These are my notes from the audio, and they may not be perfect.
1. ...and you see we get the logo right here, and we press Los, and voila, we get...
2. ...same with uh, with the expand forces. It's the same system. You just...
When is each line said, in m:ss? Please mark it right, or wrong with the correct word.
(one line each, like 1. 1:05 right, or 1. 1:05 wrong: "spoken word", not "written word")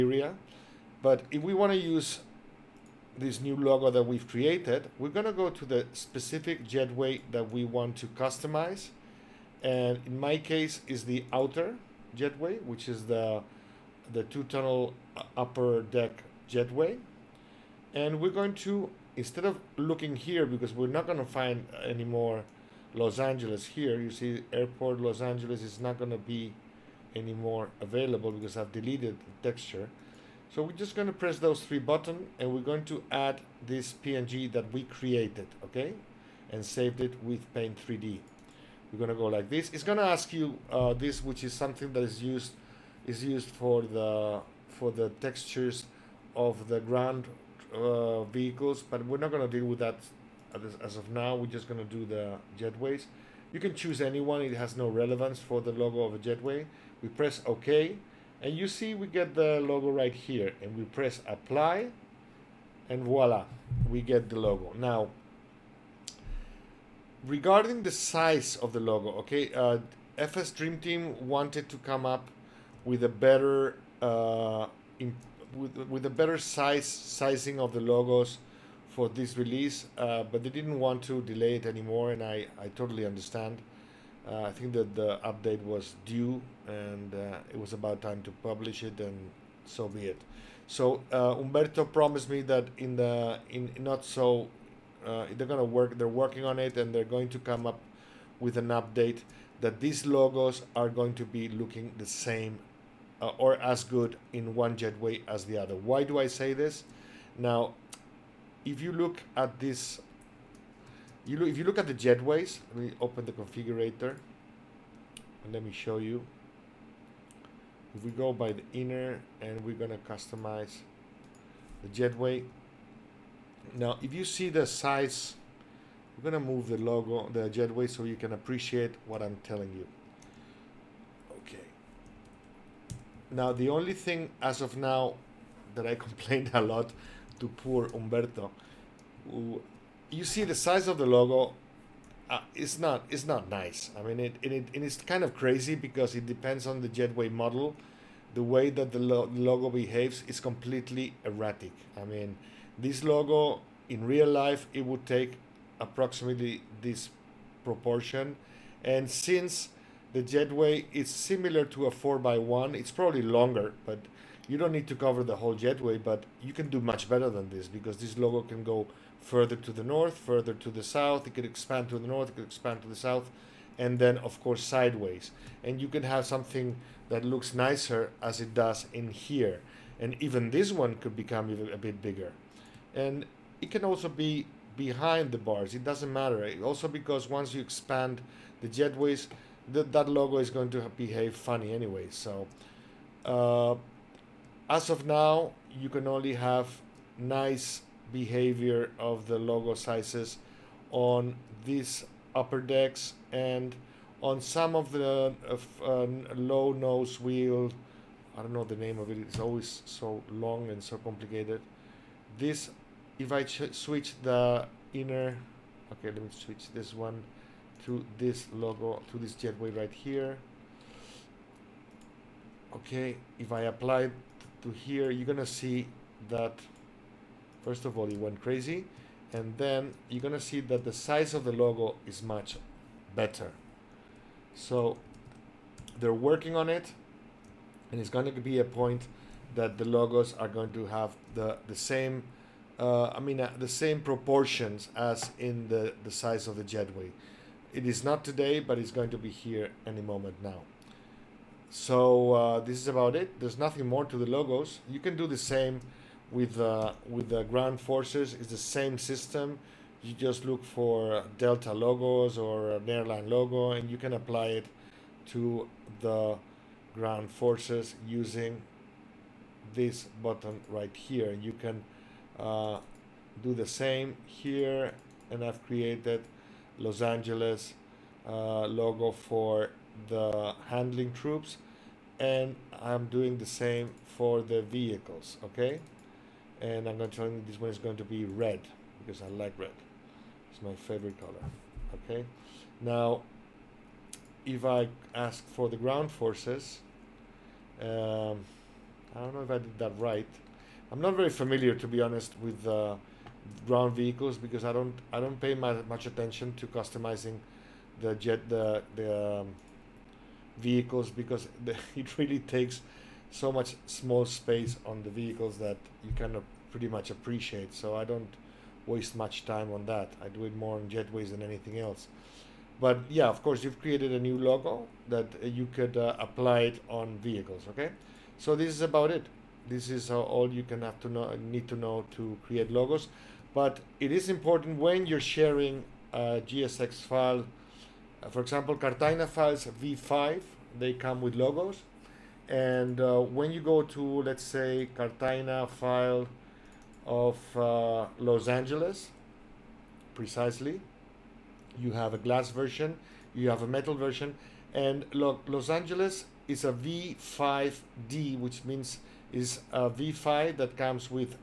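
1. 0:58 wrong: "Apply", not "Los"
2. 4:15 wrong: "ground", not "expand".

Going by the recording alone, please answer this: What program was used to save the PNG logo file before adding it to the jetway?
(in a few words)
Paint 3D.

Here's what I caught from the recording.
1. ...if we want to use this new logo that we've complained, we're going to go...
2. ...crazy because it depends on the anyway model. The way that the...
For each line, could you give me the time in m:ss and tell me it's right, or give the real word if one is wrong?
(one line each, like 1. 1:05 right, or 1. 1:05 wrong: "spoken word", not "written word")
1. 0:01 wrong: "created", not "complained"
2. 2:25 wrong: "jetway", not "anyway".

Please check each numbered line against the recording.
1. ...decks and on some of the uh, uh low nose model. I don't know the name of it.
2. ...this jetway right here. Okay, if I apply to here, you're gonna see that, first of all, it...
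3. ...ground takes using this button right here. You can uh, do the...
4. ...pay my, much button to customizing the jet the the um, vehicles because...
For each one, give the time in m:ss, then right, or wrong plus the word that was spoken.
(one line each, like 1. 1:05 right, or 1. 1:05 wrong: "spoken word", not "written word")
1. 3:22 wrong: "wheel", not "model"
2. 3:39 right
3. 4:26 wrong: "forces", not "takes"
4. 5:05 wrong: "attention", not "button".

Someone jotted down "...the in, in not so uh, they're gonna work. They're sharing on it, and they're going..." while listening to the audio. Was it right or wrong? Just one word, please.
wrong.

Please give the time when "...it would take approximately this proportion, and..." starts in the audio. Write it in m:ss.
2:34.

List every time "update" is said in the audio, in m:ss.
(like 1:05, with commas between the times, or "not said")
1:25, 1:38.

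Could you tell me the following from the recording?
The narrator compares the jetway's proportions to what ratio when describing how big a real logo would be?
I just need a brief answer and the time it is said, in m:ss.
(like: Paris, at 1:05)
4x1, at 2:41.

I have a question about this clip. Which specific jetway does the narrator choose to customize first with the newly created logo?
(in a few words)
Outer jetway.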